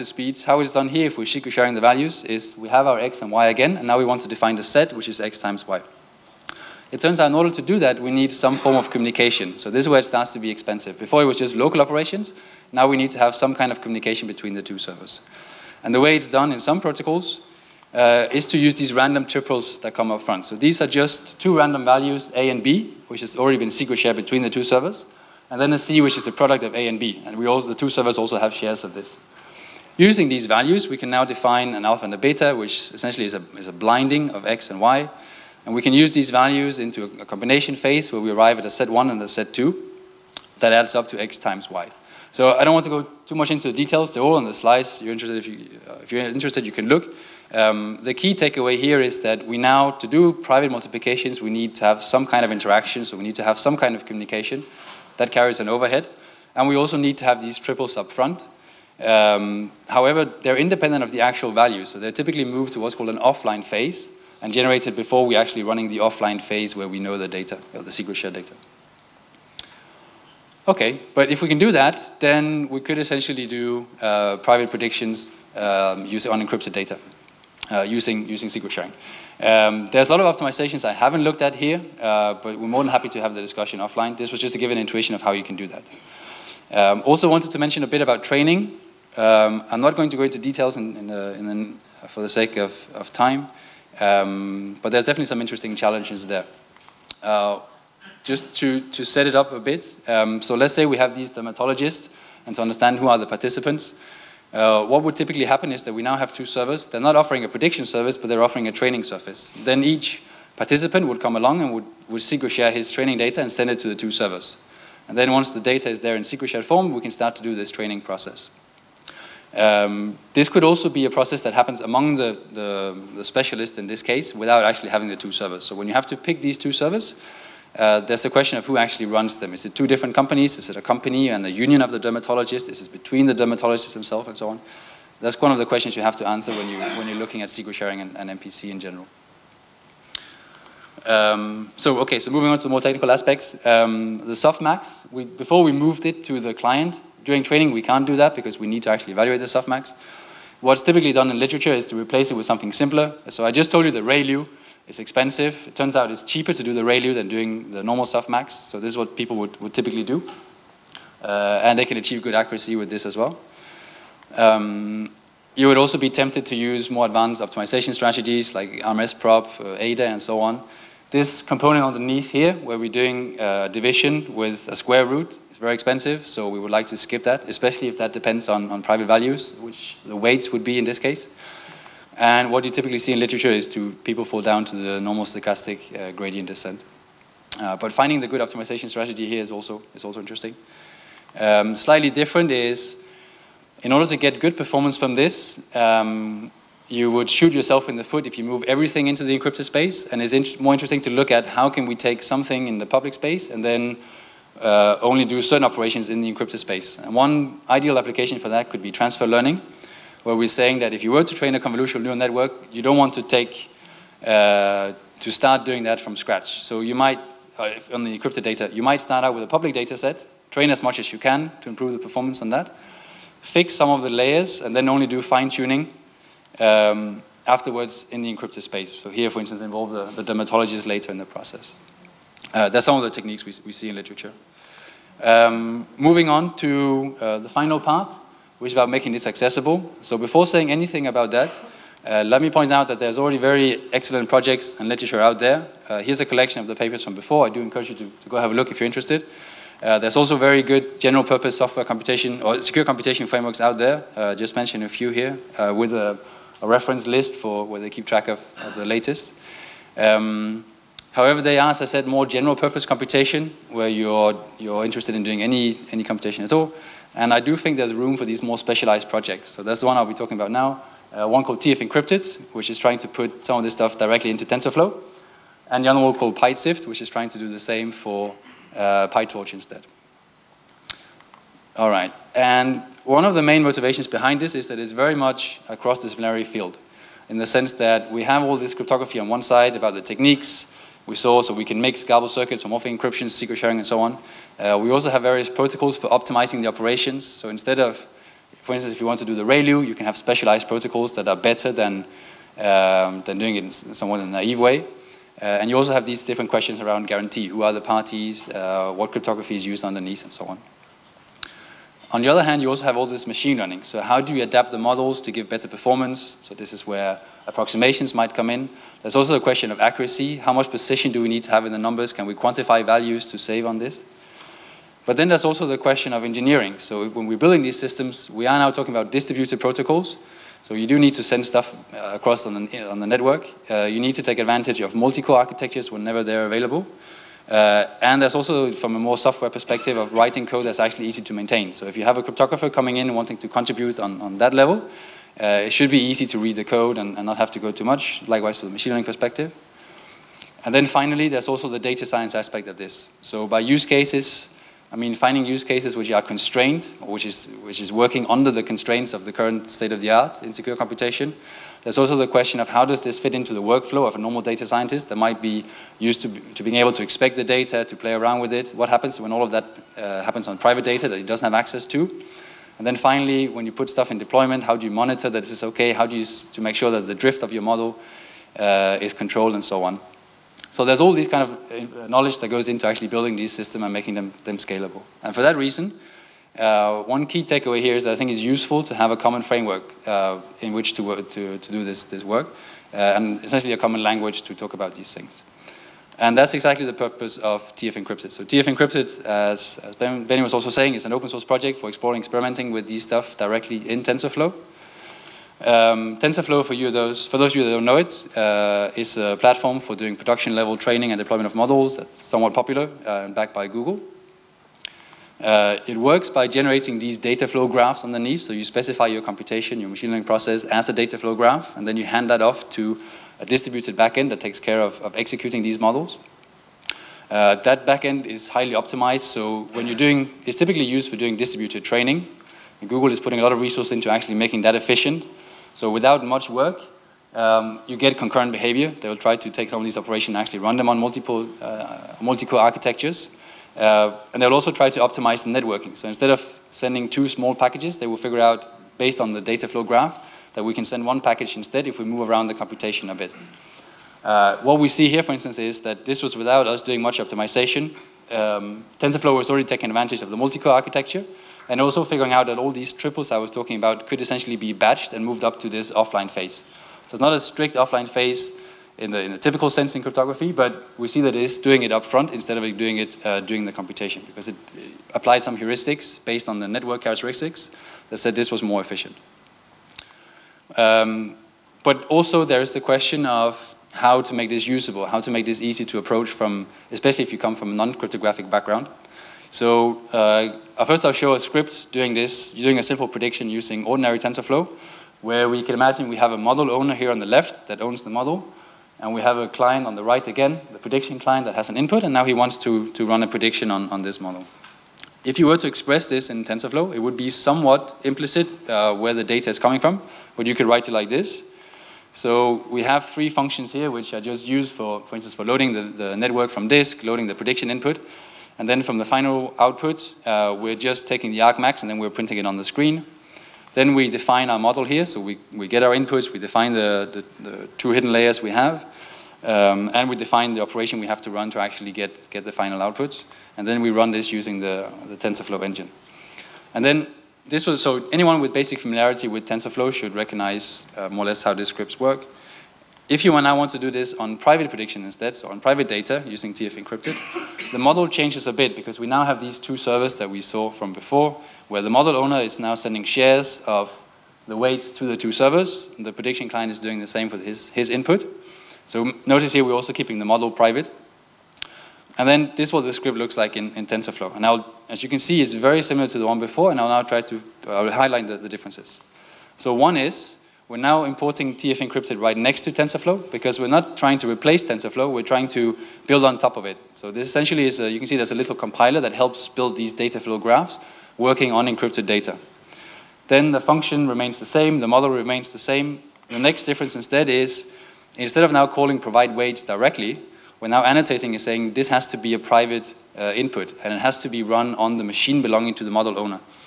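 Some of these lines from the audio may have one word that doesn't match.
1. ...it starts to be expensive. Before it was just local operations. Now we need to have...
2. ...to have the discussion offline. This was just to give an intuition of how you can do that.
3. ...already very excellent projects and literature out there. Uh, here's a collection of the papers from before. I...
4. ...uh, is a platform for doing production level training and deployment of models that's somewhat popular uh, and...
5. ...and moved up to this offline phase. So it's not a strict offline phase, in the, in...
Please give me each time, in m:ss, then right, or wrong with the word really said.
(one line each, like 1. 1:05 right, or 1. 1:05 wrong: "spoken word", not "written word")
1. 0:09 right
2. 1:23 right
3. 4:03 right
4. 6:48 right
5. 7:45 right.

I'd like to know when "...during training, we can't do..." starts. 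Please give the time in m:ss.
2:27.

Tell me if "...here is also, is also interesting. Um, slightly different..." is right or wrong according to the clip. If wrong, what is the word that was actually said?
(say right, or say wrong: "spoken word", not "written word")
right.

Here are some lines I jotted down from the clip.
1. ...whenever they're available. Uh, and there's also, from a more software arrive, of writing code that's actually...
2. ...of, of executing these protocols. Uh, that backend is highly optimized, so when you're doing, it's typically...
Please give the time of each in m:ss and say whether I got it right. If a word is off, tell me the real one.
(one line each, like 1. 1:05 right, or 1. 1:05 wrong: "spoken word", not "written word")
1. 5:35 wrong: "perspective", not "arrive"
2. 7:04 wrong: "models", not "protocols".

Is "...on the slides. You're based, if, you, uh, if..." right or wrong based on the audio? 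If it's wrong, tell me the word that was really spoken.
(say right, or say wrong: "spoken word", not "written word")
wrong: "interested", not "based".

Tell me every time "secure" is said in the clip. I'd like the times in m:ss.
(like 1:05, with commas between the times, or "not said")
4:12, 6:00.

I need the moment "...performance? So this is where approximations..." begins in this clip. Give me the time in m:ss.
5:15.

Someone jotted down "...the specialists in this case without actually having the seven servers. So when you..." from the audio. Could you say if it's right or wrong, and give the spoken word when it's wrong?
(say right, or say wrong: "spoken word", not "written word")
wrong: "two", not "seven".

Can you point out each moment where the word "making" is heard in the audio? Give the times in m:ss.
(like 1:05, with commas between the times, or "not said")
3:58, 6:23, 7:14.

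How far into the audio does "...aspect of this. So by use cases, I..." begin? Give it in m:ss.
5:52.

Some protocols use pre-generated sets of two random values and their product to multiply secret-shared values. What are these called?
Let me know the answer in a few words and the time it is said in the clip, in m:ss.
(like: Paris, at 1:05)
Random triples, at 0:18.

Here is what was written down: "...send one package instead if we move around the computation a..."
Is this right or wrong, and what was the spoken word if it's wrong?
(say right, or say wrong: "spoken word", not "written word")
right.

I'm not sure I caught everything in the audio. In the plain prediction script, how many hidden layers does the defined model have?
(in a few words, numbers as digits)
2.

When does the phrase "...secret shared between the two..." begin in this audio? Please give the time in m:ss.
0:23.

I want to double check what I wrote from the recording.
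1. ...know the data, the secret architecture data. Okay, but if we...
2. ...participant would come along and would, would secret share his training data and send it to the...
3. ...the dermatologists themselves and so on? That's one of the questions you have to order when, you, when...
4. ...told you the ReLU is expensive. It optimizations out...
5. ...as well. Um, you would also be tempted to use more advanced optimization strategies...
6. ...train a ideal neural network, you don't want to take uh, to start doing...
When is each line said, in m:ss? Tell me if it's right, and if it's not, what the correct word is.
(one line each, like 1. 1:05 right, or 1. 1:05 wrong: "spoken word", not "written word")
1. 1:06 wrong: "share", not "architecture"
2. 1:50 right
3. 2:13 wrong: "answer", not "order"
4. 2:33 wrong: "turns", not "optimizations"
5. 2:43 right
6. 3:31 wrong: "convolutional", not "ideal".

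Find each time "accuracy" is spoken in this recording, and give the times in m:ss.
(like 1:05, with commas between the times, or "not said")
2:42, 5:19.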